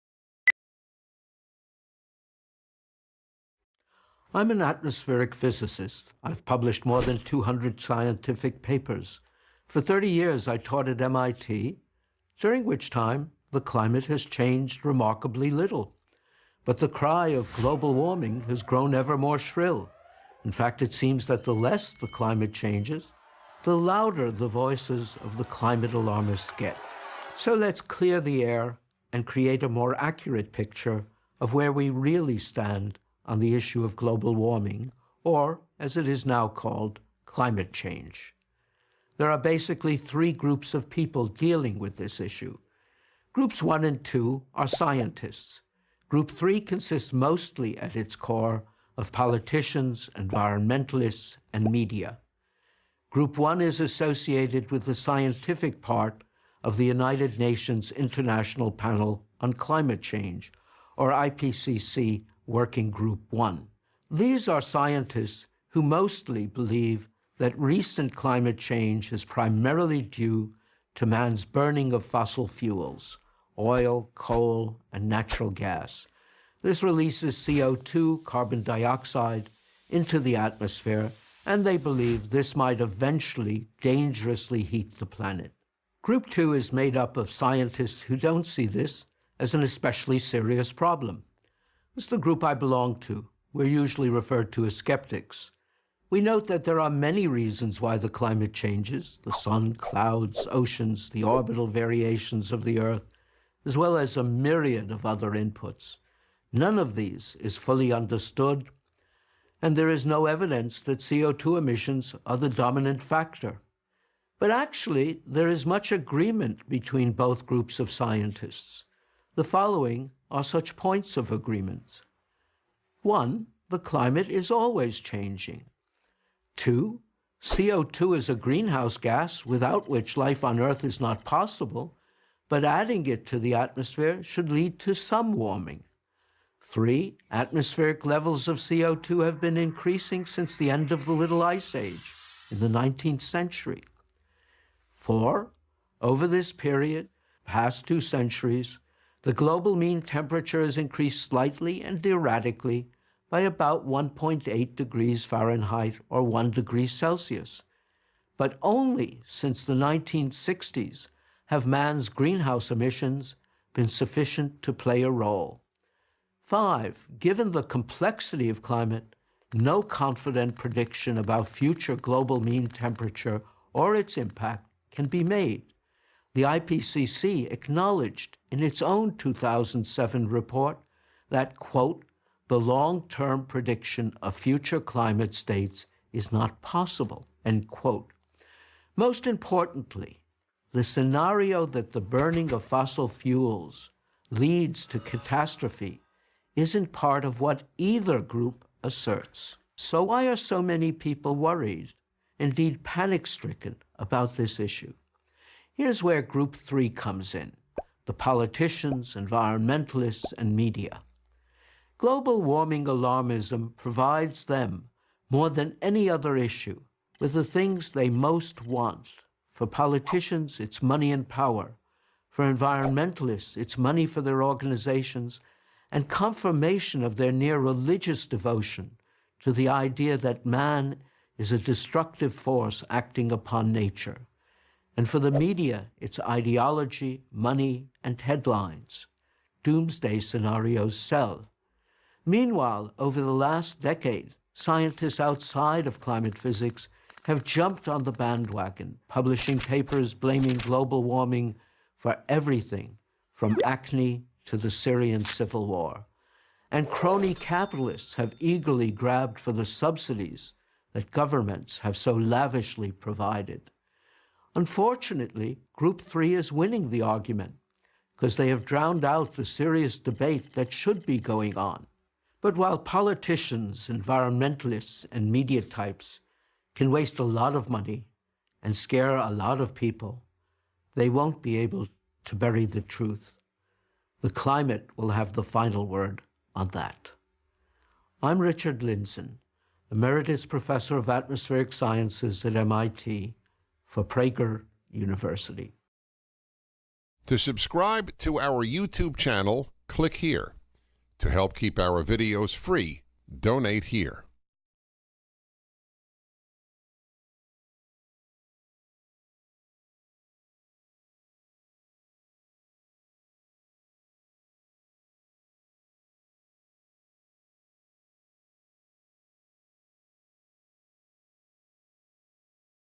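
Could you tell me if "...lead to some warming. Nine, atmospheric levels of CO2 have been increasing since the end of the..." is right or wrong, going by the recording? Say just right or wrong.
wrong.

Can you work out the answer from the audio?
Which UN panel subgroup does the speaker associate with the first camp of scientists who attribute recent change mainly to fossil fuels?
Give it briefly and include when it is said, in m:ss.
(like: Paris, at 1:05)
IPCC Working Group 1, at 1:01.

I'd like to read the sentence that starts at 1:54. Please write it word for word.
But actually, there is much agreement between both groups of scientists.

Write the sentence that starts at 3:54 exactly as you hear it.
And for the media, it's ideology, money, and headlines.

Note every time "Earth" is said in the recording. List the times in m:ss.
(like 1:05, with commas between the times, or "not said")
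1:42, 2:10.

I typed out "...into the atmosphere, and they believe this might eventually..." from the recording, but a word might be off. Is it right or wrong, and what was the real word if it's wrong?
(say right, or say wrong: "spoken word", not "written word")
right.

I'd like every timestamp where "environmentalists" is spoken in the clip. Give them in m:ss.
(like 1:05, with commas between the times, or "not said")
0:50, 3:29, 3:42, 4:33.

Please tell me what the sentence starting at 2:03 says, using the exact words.
One, the climate is always changing.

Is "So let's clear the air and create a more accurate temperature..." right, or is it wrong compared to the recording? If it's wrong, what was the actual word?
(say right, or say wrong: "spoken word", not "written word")
wrong: "picture", not "temperature".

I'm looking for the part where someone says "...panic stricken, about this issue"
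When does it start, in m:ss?
3:22.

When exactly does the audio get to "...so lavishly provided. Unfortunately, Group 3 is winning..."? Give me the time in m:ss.
4:21.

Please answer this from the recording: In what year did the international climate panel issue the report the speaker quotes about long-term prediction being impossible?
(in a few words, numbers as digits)
2007.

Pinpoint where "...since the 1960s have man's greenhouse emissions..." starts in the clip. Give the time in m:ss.
2:39.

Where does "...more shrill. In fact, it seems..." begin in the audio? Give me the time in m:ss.
0:19.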